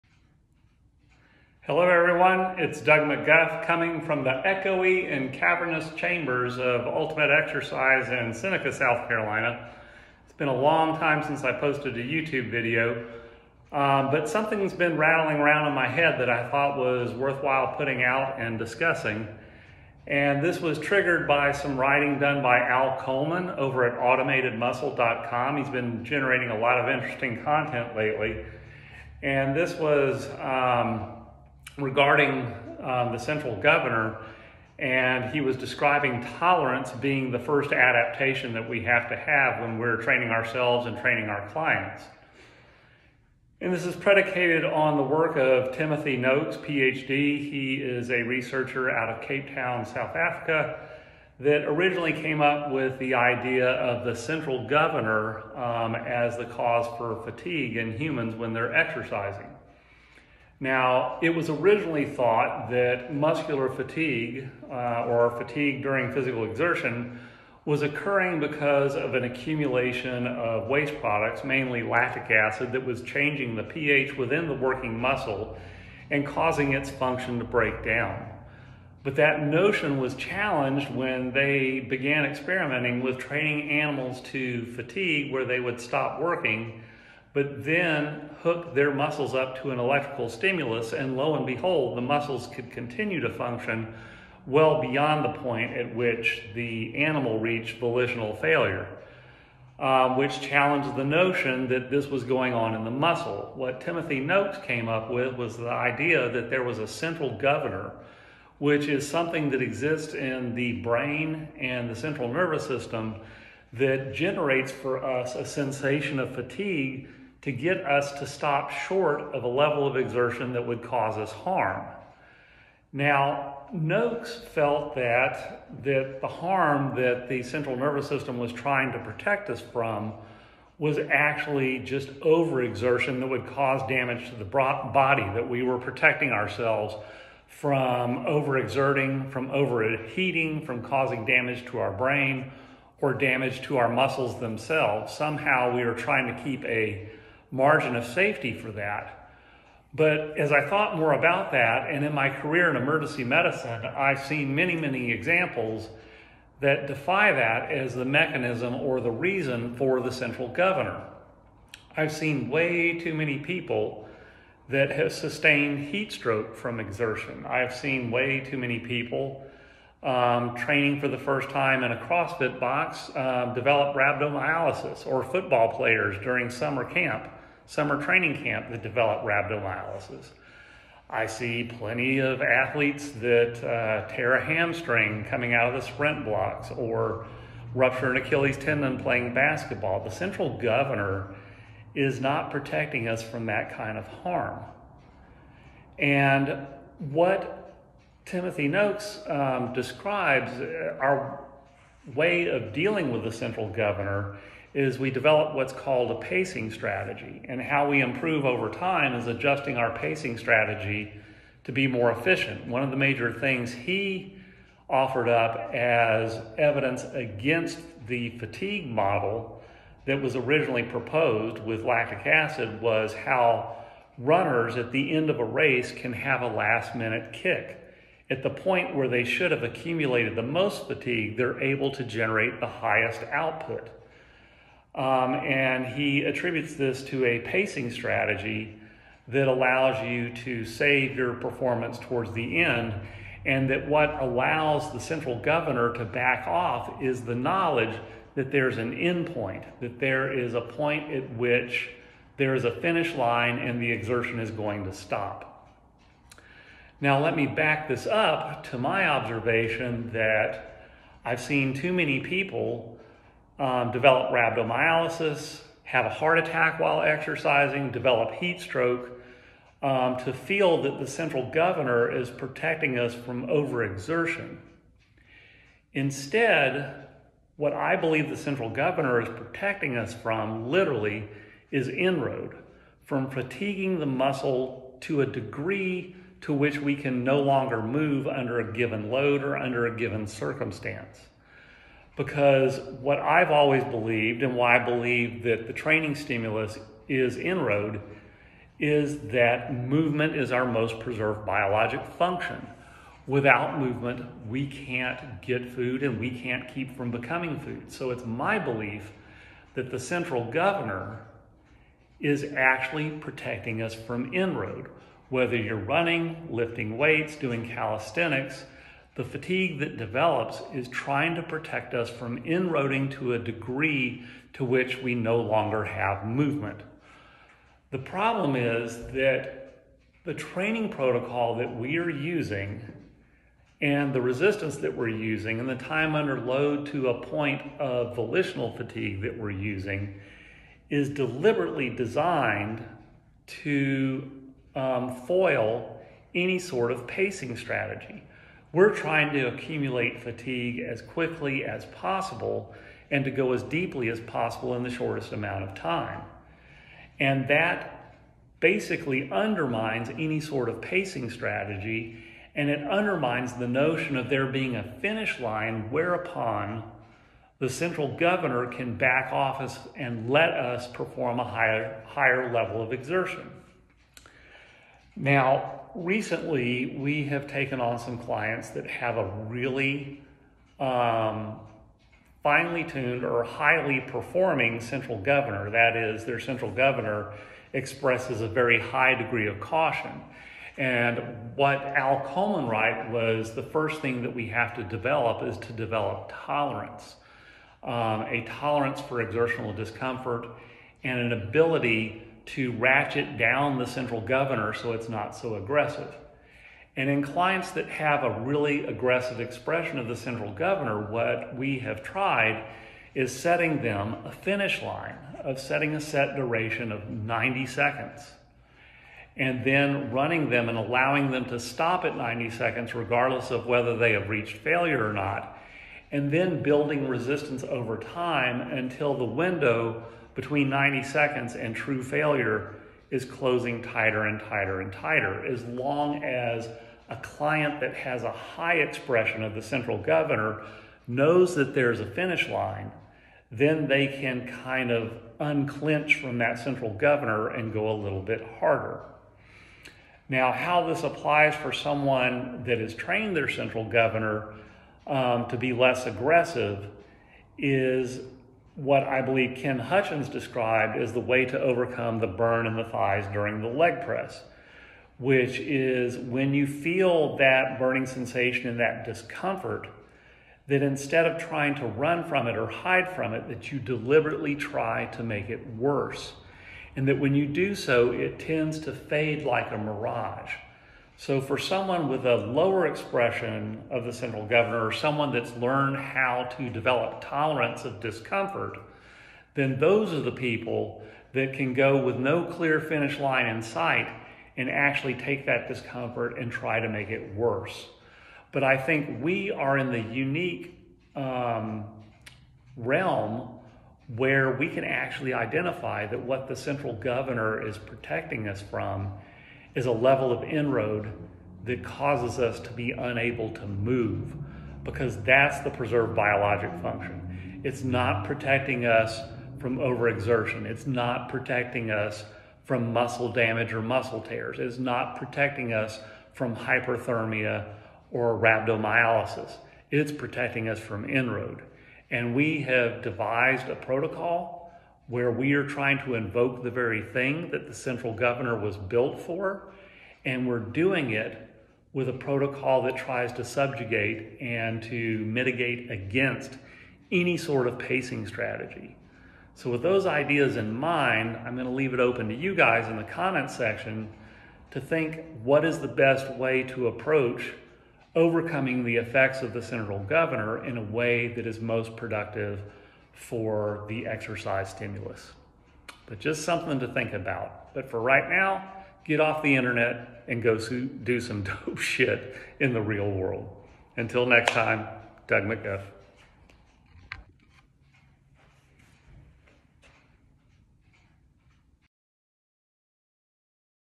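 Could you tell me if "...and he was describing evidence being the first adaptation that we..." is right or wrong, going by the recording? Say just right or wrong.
wrong.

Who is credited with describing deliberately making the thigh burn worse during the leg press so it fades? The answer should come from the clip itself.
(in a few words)
Ken Hutchins.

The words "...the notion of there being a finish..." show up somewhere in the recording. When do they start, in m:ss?
6:03.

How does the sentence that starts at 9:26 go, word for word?
But just something to think about.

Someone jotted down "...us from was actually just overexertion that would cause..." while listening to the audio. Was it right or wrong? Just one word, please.
right.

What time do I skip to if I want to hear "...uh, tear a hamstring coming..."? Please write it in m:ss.
3:03.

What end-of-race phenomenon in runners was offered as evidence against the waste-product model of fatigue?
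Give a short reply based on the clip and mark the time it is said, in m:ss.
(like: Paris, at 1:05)
last minute kick, at 3:46.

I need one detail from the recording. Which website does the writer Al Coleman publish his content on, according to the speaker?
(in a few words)
automatedmuscle.com.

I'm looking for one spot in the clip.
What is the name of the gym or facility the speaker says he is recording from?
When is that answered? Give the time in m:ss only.
0:06.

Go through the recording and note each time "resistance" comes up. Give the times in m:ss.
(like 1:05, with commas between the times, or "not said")
5:34, 7:07.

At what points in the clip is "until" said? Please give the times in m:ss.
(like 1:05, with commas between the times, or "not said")
7:08, 9:33.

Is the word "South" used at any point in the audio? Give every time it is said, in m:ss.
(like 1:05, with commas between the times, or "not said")
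0:08, 0:49.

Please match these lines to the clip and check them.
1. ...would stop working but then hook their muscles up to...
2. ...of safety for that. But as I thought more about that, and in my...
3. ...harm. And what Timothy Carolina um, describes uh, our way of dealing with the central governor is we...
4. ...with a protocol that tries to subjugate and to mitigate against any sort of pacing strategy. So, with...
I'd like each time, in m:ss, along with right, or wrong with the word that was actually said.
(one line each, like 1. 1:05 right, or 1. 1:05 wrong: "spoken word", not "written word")
1. 1:25 right
2. 2:27 right
3. 3:14 wrong: "Noakes", not "Carolina"
4. 9:01 right.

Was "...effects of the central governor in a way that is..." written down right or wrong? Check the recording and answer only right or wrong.
right.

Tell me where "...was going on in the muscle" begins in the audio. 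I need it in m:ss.
1:42.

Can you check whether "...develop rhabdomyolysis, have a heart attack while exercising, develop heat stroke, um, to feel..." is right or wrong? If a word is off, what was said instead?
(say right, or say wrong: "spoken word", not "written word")
right.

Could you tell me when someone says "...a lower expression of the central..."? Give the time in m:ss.
8:02.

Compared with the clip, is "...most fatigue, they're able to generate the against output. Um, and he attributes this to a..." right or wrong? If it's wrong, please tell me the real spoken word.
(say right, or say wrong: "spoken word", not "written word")
wrong: "highest", not "against".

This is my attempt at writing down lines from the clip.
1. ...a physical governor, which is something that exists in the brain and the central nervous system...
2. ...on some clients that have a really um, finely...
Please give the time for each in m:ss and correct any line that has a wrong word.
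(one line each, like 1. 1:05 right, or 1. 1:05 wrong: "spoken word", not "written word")
1. 1:46 wrong: "central", not "physical"
2. 6:17 right.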